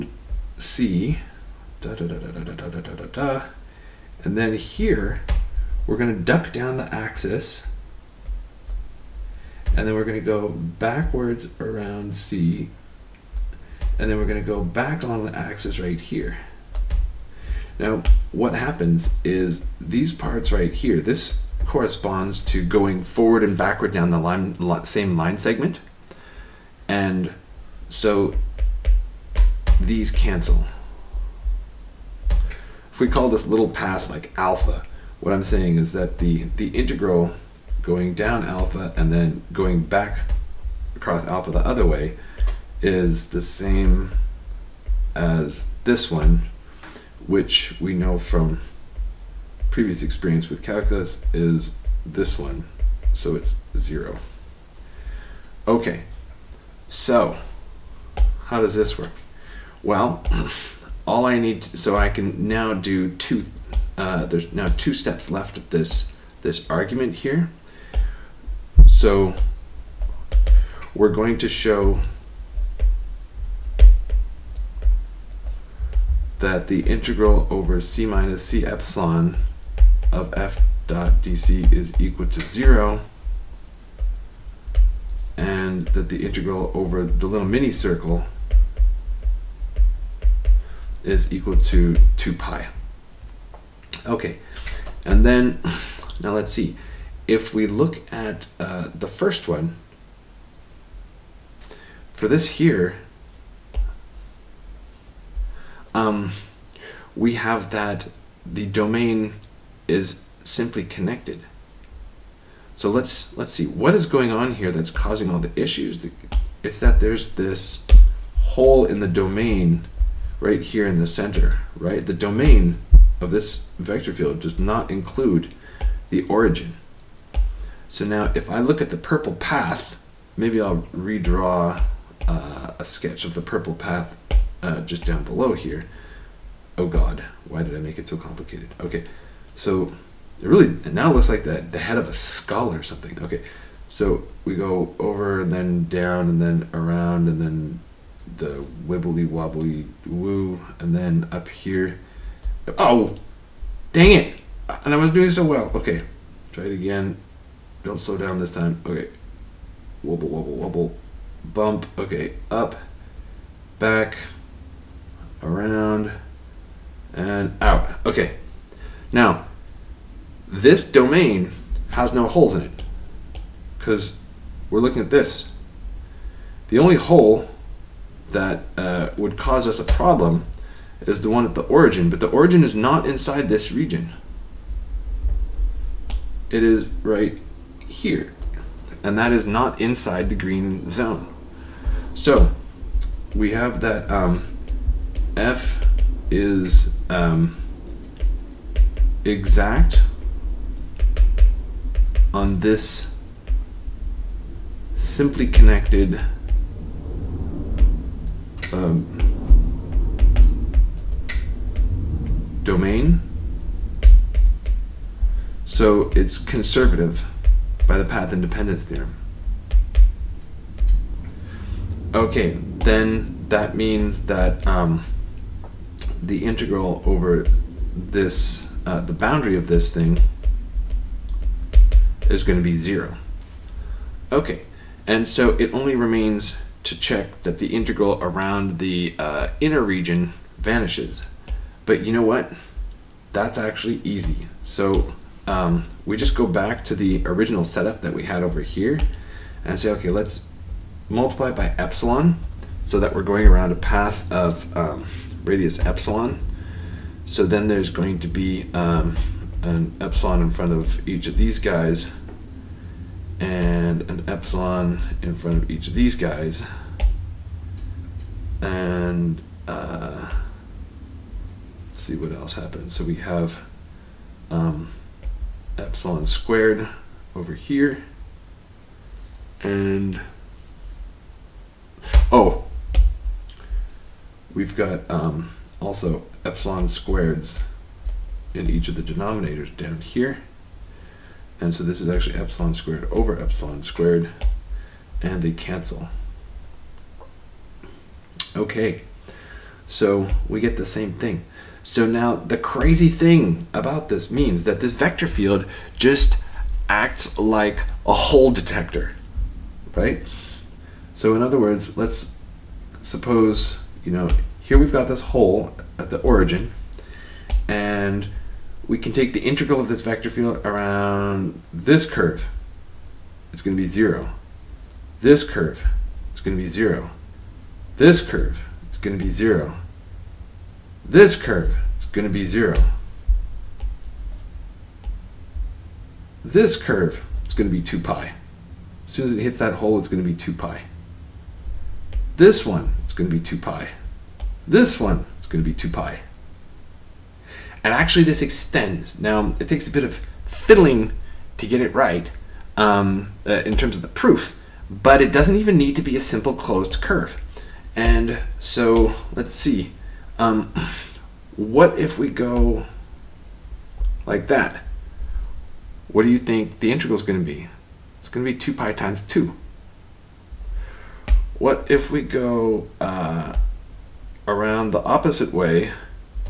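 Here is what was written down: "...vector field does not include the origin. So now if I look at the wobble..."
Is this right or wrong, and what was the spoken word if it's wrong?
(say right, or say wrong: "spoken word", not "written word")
wrong: "purple", not "wobble".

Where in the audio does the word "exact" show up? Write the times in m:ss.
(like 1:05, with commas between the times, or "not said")
3:19.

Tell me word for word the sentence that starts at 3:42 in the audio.
Okay, then that means that um, the integral over this uh, the boundary of this thing is going to be 0.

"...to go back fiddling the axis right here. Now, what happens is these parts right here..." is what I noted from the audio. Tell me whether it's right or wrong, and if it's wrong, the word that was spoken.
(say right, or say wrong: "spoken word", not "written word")
wrong: "along", not "fiddling".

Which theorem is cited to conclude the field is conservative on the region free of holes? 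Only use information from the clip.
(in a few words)
path independence theorem.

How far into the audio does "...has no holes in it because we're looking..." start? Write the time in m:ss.
2:51.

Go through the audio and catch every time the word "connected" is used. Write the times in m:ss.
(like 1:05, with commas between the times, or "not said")
1:50, 3:25.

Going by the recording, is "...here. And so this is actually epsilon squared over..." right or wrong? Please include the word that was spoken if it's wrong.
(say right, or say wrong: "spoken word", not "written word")
right.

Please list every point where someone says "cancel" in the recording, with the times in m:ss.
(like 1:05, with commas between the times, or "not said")
0:30, 4:55.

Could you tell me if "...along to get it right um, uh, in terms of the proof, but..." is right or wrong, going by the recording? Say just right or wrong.
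wrong.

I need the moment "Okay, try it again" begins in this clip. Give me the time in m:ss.
2:35.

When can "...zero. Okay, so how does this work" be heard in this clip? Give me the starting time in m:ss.
0:53.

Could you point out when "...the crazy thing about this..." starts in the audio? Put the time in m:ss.
5:02.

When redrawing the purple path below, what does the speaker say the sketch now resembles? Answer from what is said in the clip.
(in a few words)
head of a skull.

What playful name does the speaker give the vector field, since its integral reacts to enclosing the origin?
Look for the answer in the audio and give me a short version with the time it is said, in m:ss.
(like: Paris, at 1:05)
hole detector, at 5:08.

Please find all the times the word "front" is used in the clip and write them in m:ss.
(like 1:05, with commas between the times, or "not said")
4:20, 4:25.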